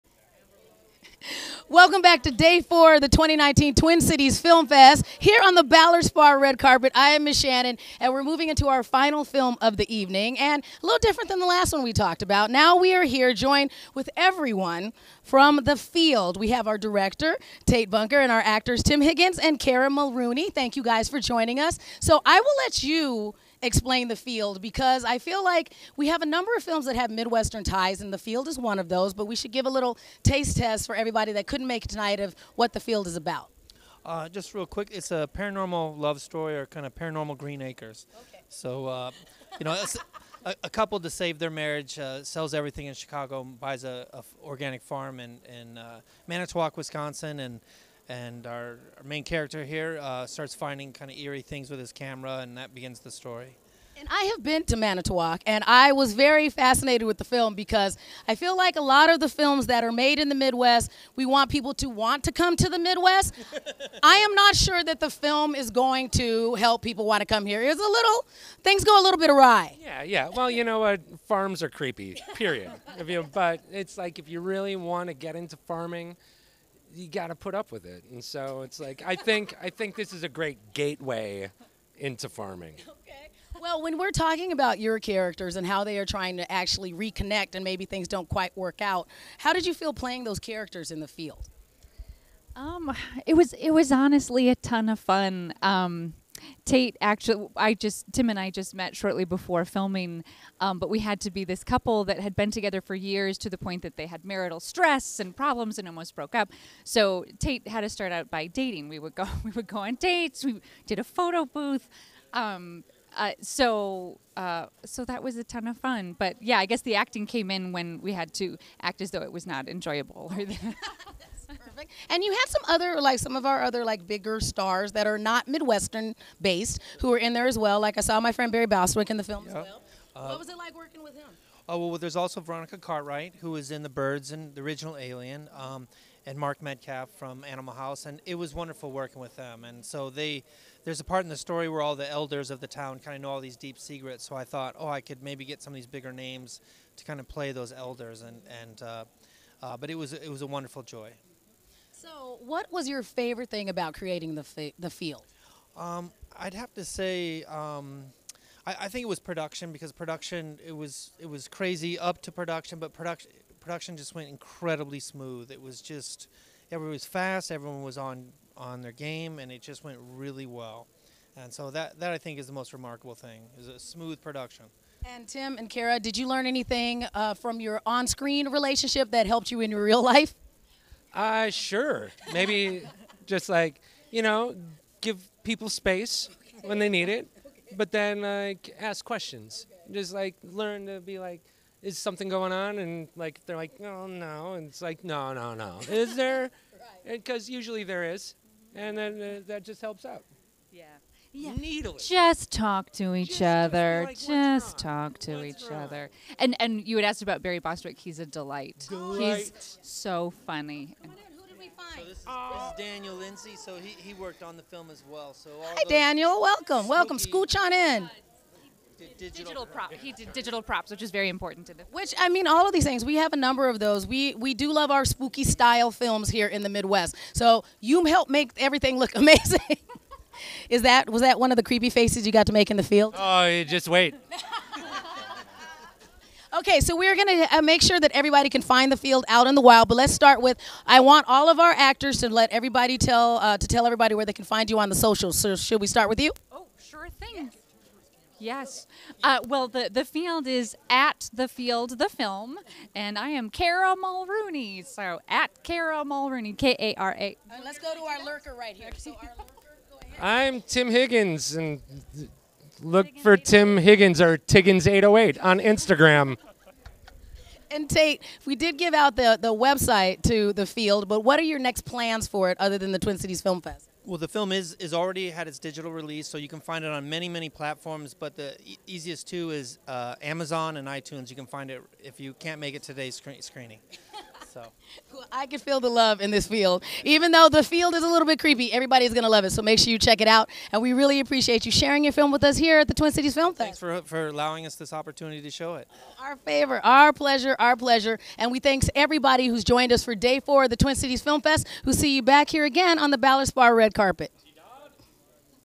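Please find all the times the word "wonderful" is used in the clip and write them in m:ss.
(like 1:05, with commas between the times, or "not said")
2:18, 2:30.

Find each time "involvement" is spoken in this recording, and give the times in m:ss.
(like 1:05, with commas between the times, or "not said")
not said.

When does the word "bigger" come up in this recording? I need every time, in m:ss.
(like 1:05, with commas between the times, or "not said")
2:04, 2:25.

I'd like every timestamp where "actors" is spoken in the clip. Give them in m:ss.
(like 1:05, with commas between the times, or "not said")
0:18, 4:01.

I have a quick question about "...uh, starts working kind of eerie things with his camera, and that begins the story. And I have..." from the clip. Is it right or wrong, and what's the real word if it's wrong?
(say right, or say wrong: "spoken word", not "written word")
wrong: "finding", not "working".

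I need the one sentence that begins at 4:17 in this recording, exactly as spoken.
let's go to our lurker right here.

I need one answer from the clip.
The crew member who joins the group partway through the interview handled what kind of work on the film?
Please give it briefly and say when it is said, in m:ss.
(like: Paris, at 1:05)
Digital props, at 3:40.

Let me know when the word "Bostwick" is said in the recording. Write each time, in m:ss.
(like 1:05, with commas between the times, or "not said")
2:08, 3:27.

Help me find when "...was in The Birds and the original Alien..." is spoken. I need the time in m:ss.
2:13.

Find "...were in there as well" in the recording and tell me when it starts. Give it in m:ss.
2:07.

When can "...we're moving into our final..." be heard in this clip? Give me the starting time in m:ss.
0:08.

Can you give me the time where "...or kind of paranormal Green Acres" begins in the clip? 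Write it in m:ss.
0:36.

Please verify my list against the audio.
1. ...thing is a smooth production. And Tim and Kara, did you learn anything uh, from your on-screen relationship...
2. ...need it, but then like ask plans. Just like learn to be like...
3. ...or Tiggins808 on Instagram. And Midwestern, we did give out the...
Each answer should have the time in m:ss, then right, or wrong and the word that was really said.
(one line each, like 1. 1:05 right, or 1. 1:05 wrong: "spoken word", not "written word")
1. 2:53 right
2. 3:06 wrong: "questions", not "plans"
3. 4:24 wrong: "Tate", not "Midwestern".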